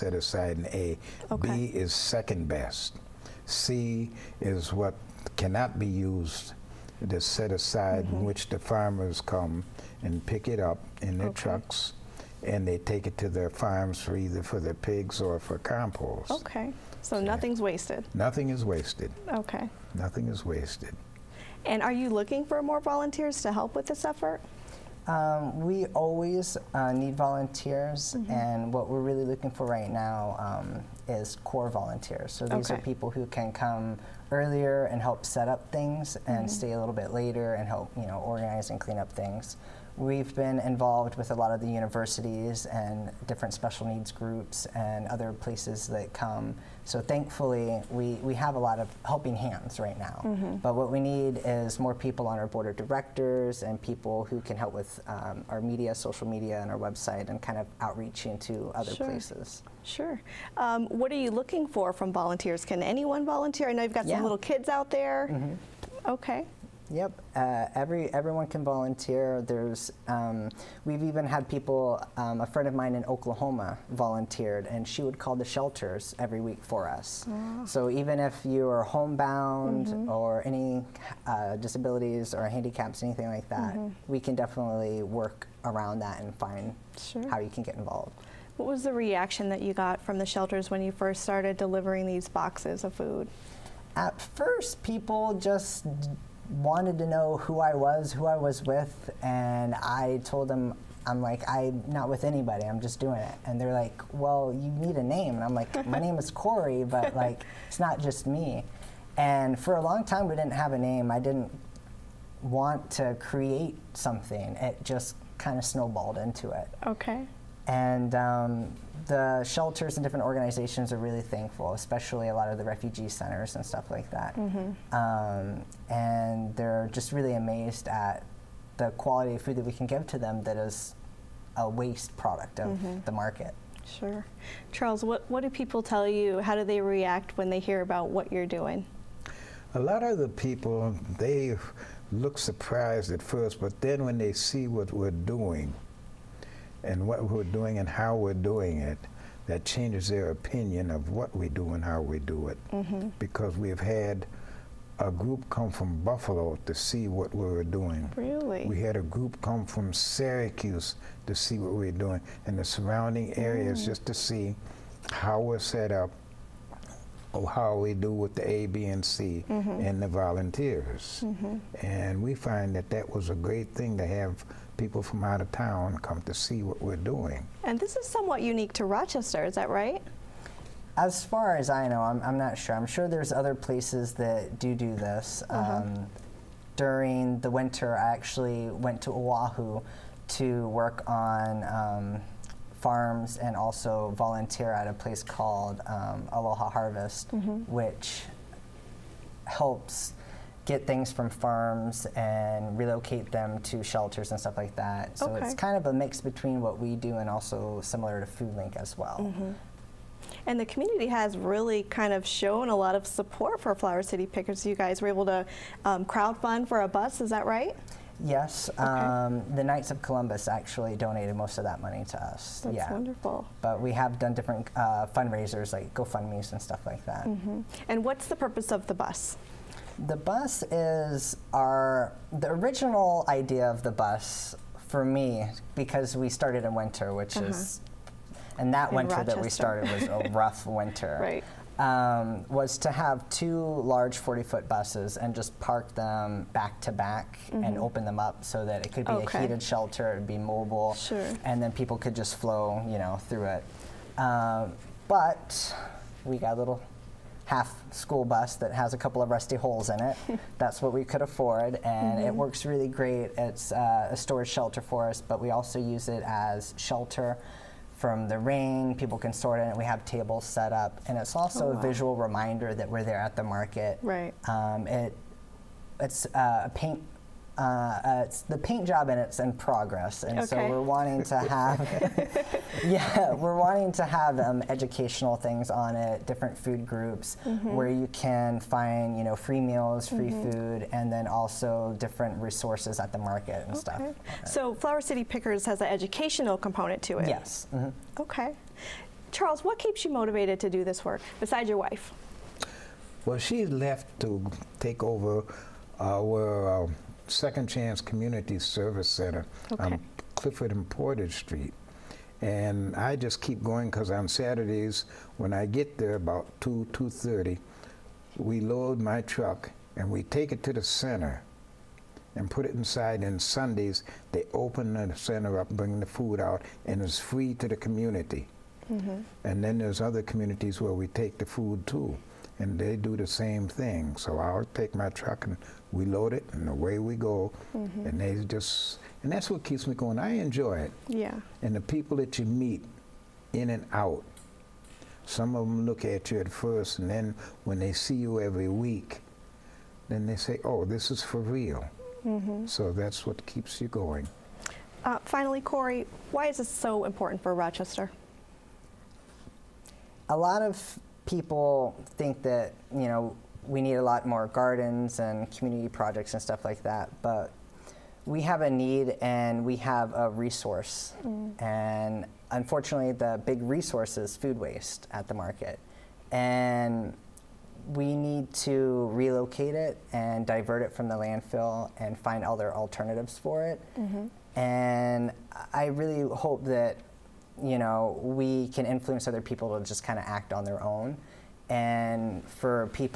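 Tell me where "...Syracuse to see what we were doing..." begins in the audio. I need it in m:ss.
2:39.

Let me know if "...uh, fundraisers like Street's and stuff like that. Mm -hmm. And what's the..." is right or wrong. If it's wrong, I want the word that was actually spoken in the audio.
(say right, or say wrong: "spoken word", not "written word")
wrong: "GoFundMe", not "Street".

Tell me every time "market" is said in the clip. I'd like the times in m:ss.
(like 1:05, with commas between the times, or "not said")
2:13, 4:33, 4:53, 6:15.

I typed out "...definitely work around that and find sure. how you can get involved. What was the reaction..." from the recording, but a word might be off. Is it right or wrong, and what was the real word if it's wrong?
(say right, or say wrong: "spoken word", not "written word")
right.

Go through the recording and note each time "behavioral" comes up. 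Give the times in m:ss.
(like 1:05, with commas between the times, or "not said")
not said.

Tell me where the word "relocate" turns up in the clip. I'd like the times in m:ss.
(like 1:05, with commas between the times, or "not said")
3:22, 6:19.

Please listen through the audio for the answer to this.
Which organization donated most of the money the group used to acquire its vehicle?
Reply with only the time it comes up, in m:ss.
3:39.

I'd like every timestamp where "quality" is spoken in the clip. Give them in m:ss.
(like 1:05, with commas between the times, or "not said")
2:08.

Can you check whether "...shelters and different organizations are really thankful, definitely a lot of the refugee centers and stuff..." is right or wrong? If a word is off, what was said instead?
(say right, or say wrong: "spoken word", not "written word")
wrong: "especially", not "definitely".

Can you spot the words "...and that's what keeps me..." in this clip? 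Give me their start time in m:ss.
5:39.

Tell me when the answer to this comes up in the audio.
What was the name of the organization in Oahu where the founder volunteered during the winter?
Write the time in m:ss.
3:16.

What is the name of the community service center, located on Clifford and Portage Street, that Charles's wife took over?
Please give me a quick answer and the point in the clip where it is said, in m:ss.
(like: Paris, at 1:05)
Second Chance Community Service Center, at 5:07.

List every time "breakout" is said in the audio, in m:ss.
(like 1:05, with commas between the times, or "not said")
not said.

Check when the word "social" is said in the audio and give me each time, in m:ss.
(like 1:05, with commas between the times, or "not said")
0:55.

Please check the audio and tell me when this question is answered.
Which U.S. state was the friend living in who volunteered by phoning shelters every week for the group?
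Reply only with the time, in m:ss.
1:13.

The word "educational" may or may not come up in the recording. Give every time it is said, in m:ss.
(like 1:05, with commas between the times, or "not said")
4:44, 4:55.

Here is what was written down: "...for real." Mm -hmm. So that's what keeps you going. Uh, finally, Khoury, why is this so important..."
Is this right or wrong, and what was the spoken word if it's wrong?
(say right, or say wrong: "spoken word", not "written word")
right.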